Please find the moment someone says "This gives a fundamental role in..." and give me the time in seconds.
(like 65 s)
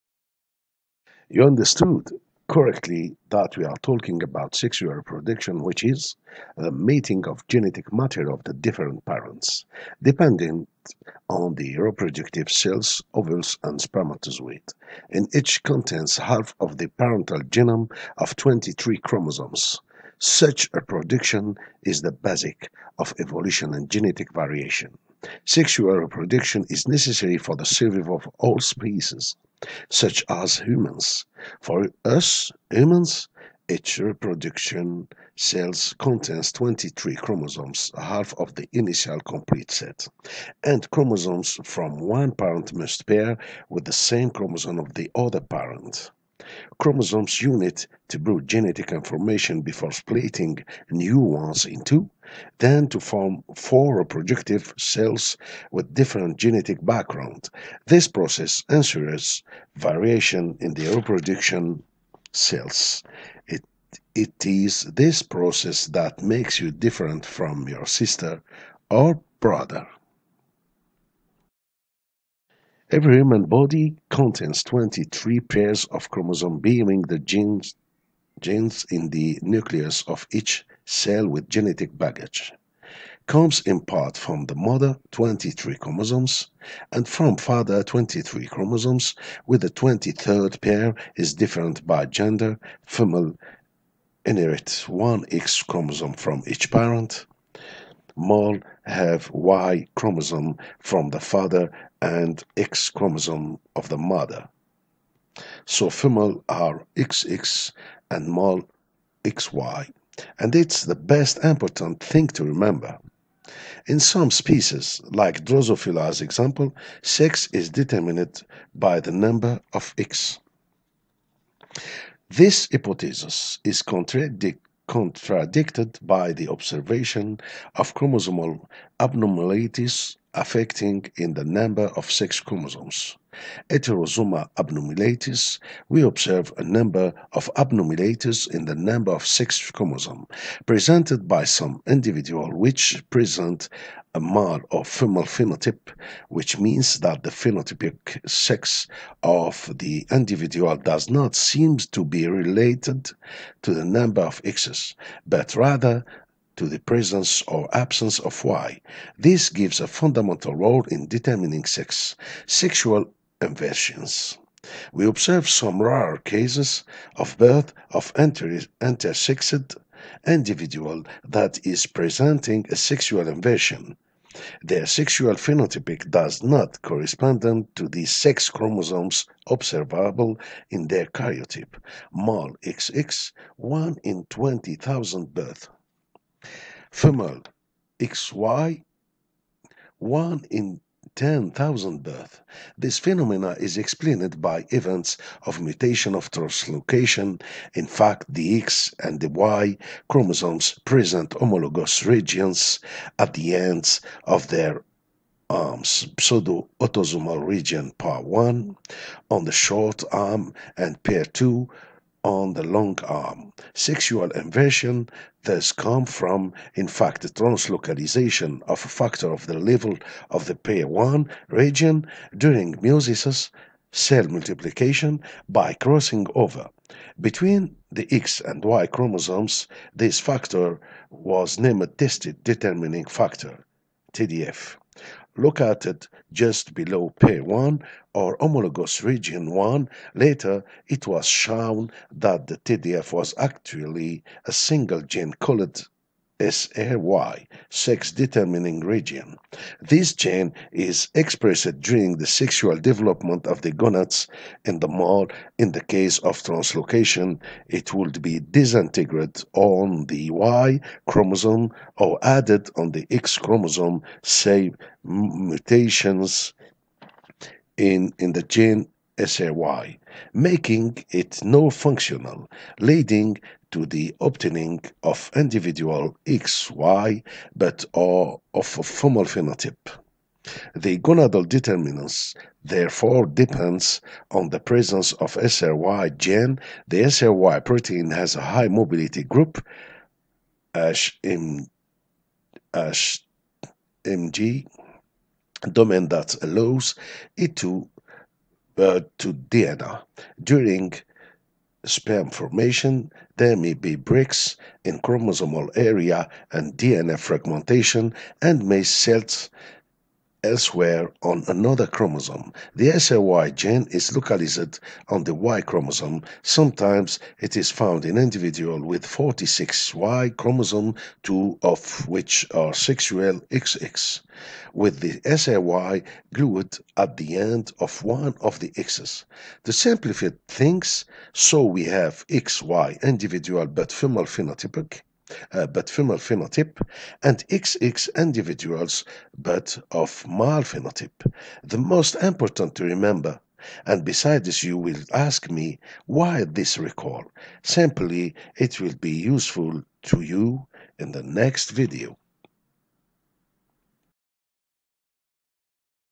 159 s.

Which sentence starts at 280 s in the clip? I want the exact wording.
The gonadal determinants therefore depends on the presence of SRY gene.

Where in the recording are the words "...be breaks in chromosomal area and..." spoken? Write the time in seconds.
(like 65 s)
303 s.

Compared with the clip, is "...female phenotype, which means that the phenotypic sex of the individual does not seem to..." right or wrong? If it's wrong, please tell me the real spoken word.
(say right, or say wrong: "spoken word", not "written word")
right.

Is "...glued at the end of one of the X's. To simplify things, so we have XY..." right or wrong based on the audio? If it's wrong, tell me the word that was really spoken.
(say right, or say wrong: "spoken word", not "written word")
right.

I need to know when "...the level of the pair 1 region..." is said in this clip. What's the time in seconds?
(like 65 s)
219 s.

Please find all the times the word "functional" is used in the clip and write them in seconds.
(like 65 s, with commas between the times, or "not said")
271 s.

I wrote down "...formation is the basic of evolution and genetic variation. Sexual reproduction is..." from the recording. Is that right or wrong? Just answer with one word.
wrong.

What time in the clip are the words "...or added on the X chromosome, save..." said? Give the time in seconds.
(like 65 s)
261 s.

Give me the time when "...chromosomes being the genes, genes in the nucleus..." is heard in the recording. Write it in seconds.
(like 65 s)
76 s.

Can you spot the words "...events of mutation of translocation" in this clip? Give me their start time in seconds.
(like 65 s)
194 s.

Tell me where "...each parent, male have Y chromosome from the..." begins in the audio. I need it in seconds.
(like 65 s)
96 s.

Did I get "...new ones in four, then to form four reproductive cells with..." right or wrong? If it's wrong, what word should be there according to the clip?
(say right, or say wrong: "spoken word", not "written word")
wrong: "two", not "four".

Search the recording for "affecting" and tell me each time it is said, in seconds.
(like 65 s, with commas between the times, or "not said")
130 s.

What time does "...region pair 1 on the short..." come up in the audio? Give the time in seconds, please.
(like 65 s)
207 s.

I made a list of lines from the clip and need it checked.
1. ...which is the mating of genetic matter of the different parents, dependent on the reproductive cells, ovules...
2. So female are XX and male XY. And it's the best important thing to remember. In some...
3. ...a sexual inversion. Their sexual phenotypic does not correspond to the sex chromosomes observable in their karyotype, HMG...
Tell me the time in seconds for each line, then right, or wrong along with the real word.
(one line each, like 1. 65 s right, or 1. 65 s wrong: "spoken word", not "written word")
1. 5 s right
2. 105 s right
3. 172 s wrong: "Male", not "HMG".